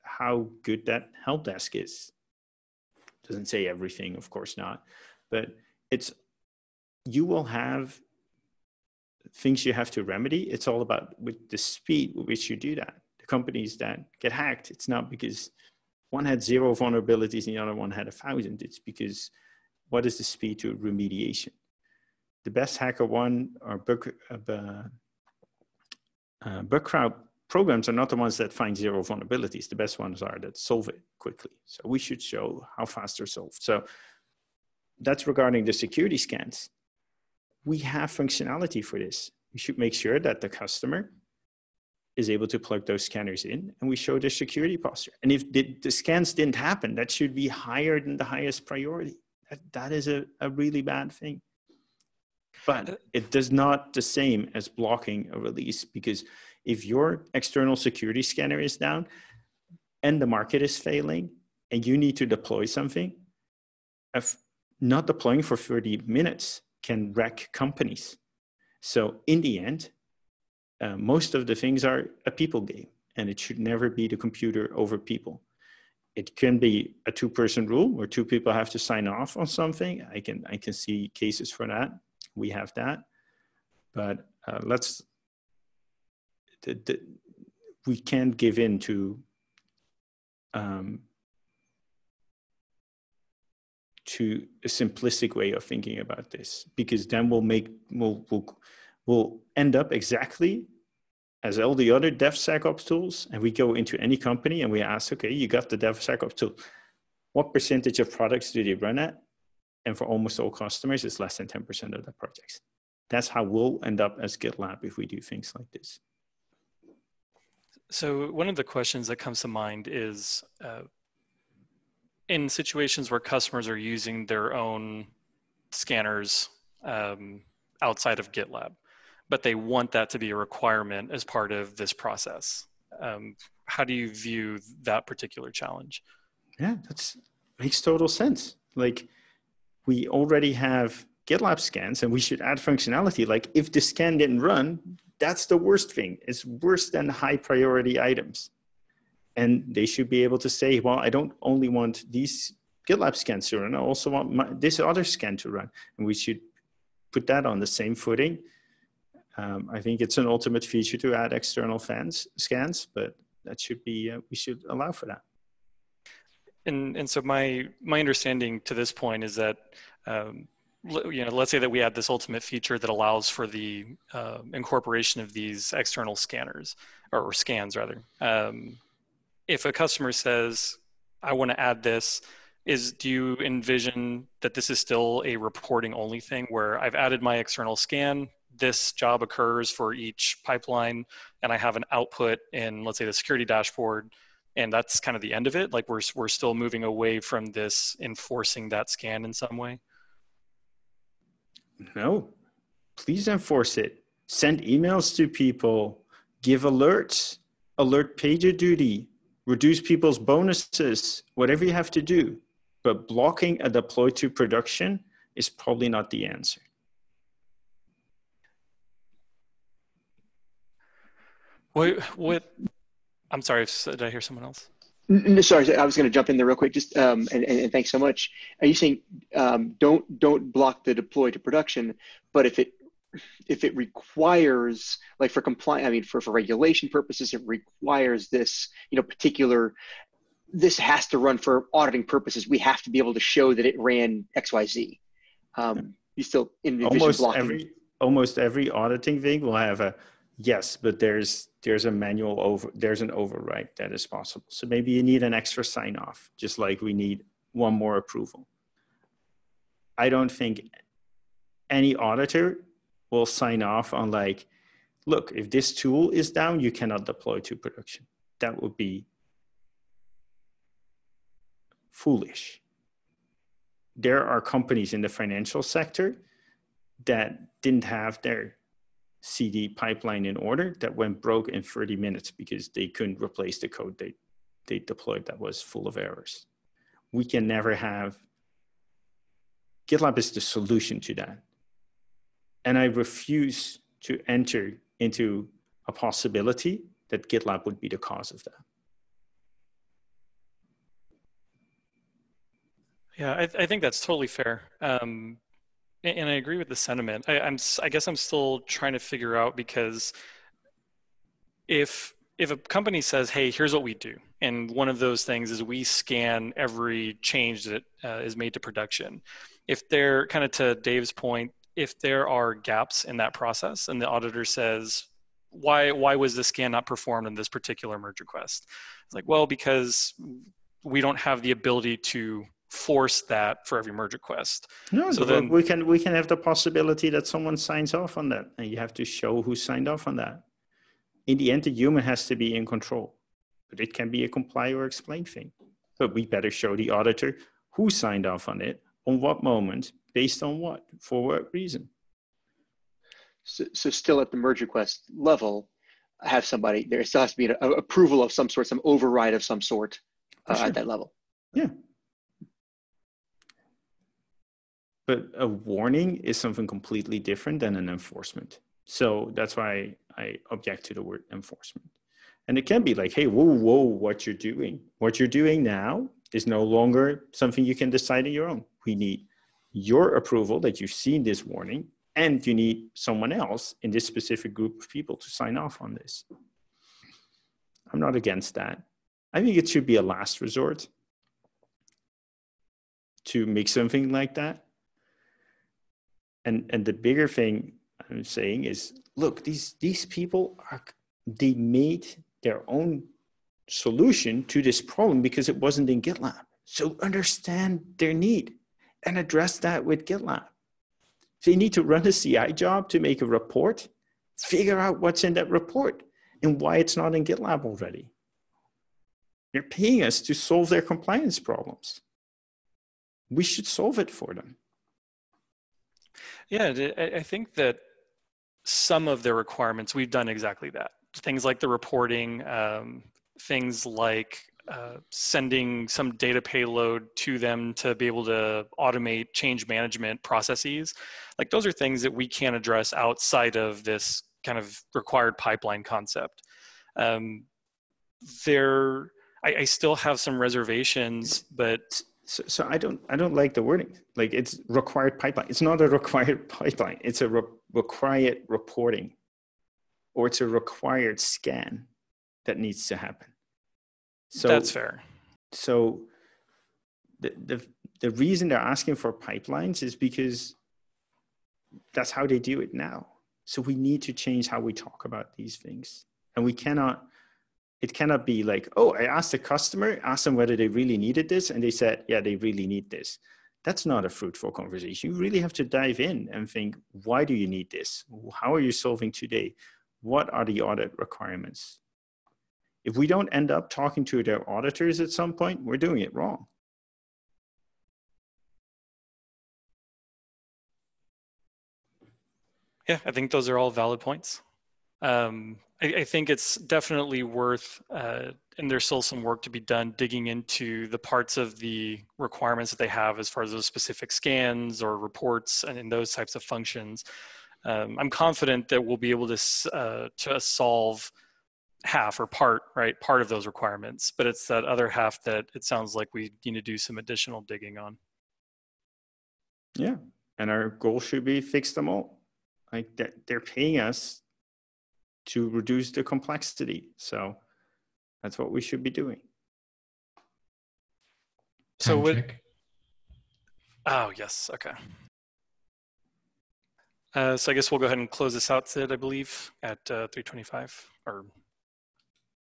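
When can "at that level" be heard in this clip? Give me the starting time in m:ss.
6:00.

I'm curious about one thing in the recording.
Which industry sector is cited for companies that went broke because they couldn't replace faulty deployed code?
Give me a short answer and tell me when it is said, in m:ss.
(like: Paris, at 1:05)
financial sector, at 4:35.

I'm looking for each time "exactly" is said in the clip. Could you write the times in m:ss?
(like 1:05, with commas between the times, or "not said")
1:39, 7:10.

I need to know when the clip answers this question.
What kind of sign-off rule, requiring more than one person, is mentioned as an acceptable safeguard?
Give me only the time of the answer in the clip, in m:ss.
1:17.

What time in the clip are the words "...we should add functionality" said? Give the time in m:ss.
2:22.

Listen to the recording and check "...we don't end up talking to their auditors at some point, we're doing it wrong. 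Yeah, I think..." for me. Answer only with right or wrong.
right.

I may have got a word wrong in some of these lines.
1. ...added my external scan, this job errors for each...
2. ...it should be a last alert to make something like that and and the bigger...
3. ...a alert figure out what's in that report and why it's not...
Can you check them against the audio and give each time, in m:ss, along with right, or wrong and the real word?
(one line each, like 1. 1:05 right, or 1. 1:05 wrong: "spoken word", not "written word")
1. 3:06 wrong: "occurs", not "errors"
2. 6:29 wrong: "resort", not "alert"
3. 6:53 wrong: "report", not "alert".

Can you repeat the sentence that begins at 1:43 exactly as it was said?
And we go into any company and we ask, okay, you got the DevSecOps tool.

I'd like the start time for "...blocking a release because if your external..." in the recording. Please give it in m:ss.
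0:54.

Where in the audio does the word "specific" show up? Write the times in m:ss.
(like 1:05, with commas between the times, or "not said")
6:24, 8:33.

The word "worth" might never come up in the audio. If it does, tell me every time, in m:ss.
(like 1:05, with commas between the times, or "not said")
8:27.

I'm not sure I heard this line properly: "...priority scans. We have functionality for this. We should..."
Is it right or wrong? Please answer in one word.
wrong.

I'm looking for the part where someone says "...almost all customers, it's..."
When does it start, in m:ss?
1:50.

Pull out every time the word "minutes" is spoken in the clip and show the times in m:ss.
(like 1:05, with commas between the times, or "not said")
1:06, 4:41.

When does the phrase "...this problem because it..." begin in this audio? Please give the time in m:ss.
6:44.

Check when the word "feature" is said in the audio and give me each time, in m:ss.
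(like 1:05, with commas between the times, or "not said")
2:40, 2:52.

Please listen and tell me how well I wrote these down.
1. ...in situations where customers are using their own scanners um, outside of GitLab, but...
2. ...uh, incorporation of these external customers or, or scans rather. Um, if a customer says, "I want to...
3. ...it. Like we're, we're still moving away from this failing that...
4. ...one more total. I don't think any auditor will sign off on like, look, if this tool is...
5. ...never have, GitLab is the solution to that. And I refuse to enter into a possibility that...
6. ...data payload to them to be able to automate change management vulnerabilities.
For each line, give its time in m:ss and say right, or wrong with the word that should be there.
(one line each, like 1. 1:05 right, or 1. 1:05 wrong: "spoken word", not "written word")
1. 2:02 right
2. 2:54 wrong: "scanners", not "customers"
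3. 3:15 wrong: "enforcing", not "failing"
4. 4:17 wrong: "approval", not "total"
5. 4:47 right
6. 7:16 wrong: "processes", not "vulnerabilities".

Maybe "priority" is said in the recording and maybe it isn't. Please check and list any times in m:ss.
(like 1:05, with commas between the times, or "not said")
0:48, 2:27.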